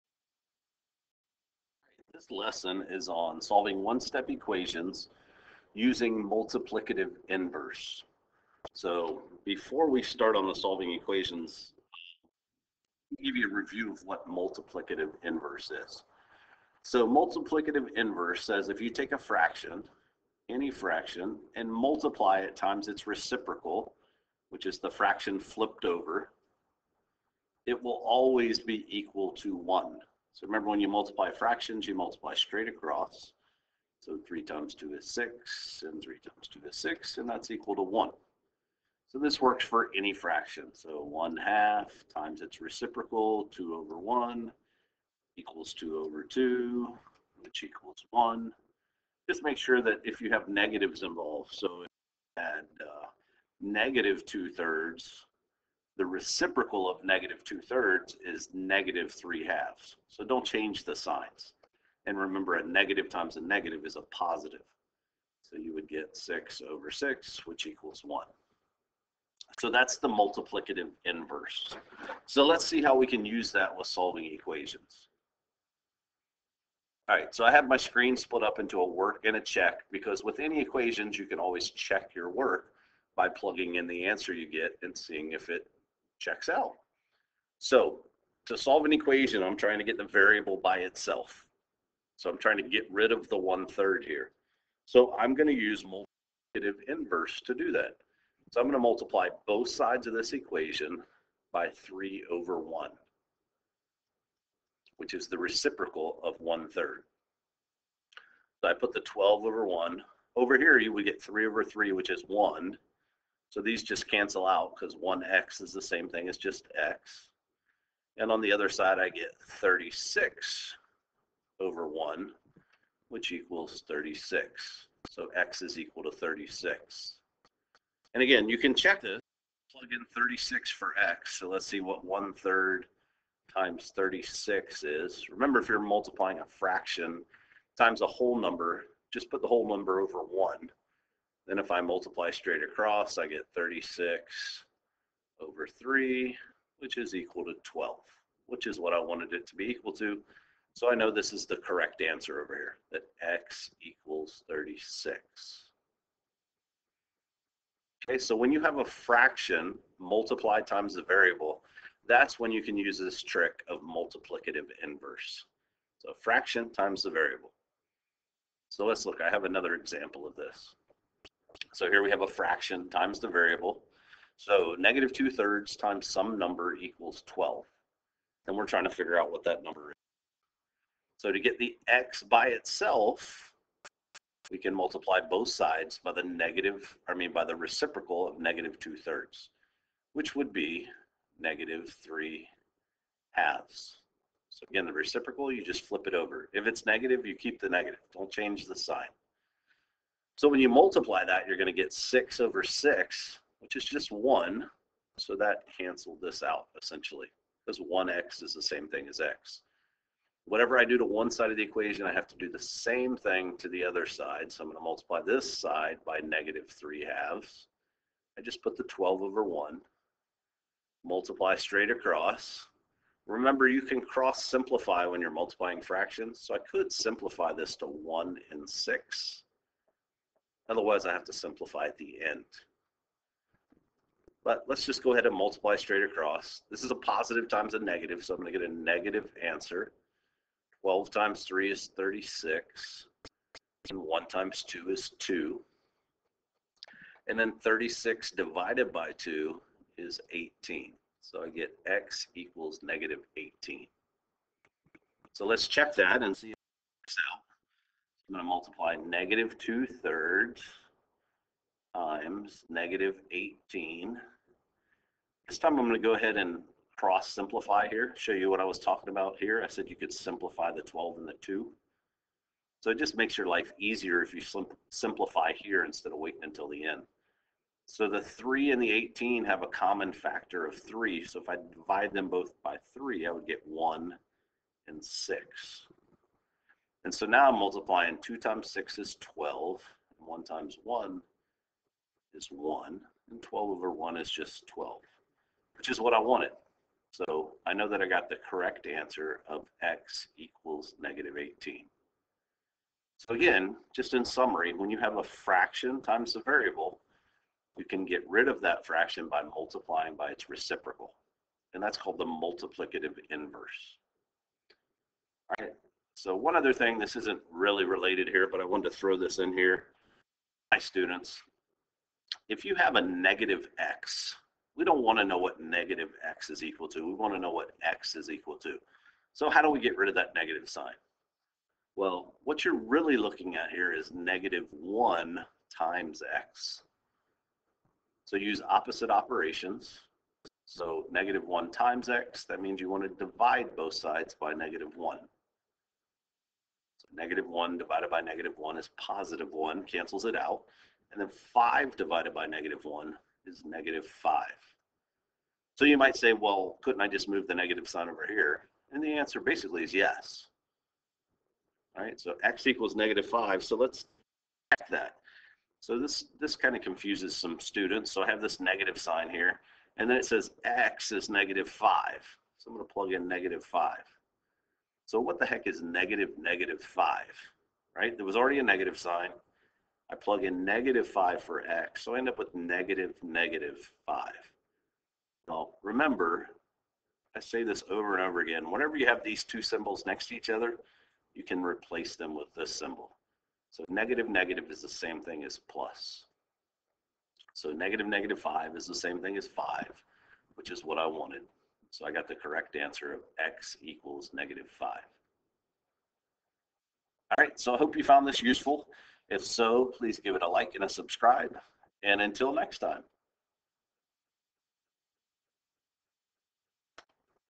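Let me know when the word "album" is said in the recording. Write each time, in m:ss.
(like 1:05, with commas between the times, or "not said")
not said.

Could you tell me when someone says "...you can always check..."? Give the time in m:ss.
1:21.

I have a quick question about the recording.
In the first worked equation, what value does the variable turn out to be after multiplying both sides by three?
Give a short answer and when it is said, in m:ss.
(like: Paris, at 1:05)
36, at 2:05.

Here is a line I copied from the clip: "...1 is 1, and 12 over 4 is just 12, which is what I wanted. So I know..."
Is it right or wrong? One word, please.
wrong.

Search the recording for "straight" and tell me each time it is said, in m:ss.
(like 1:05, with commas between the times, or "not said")
0:32, 2:22, 3:41, 3:55.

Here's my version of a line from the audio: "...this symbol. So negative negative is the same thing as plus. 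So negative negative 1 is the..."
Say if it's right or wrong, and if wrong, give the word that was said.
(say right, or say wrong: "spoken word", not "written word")
wrong: "5", not "1".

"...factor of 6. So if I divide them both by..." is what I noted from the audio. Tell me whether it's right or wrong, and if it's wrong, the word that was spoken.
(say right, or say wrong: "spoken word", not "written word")
wrong: "3", not "6".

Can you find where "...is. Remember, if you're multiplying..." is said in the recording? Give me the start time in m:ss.
2:14.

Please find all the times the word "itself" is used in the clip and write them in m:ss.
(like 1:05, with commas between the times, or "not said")
1:30, 3:02.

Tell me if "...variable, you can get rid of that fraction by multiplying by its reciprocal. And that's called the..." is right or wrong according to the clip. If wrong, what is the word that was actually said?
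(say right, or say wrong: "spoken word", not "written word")
right.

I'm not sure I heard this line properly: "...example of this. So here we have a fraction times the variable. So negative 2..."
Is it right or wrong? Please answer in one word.
right.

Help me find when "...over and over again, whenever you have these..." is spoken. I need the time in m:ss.
6:27.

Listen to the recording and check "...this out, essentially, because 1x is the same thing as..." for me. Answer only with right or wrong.
right.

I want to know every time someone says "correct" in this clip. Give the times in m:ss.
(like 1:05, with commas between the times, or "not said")
2:31, 4:58, 6:42.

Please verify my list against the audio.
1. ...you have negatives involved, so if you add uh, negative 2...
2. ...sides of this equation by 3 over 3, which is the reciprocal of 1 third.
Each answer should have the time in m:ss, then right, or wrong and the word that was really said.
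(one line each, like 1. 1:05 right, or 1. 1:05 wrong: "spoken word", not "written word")
1. 0:50 right
2. 1:39 wrong: "1", not "3".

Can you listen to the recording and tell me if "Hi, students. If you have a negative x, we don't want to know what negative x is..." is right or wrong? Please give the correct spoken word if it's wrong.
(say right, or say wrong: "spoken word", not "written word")
right.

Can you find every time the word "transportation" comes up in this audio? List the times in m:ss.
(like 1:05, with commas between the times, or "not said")
not said.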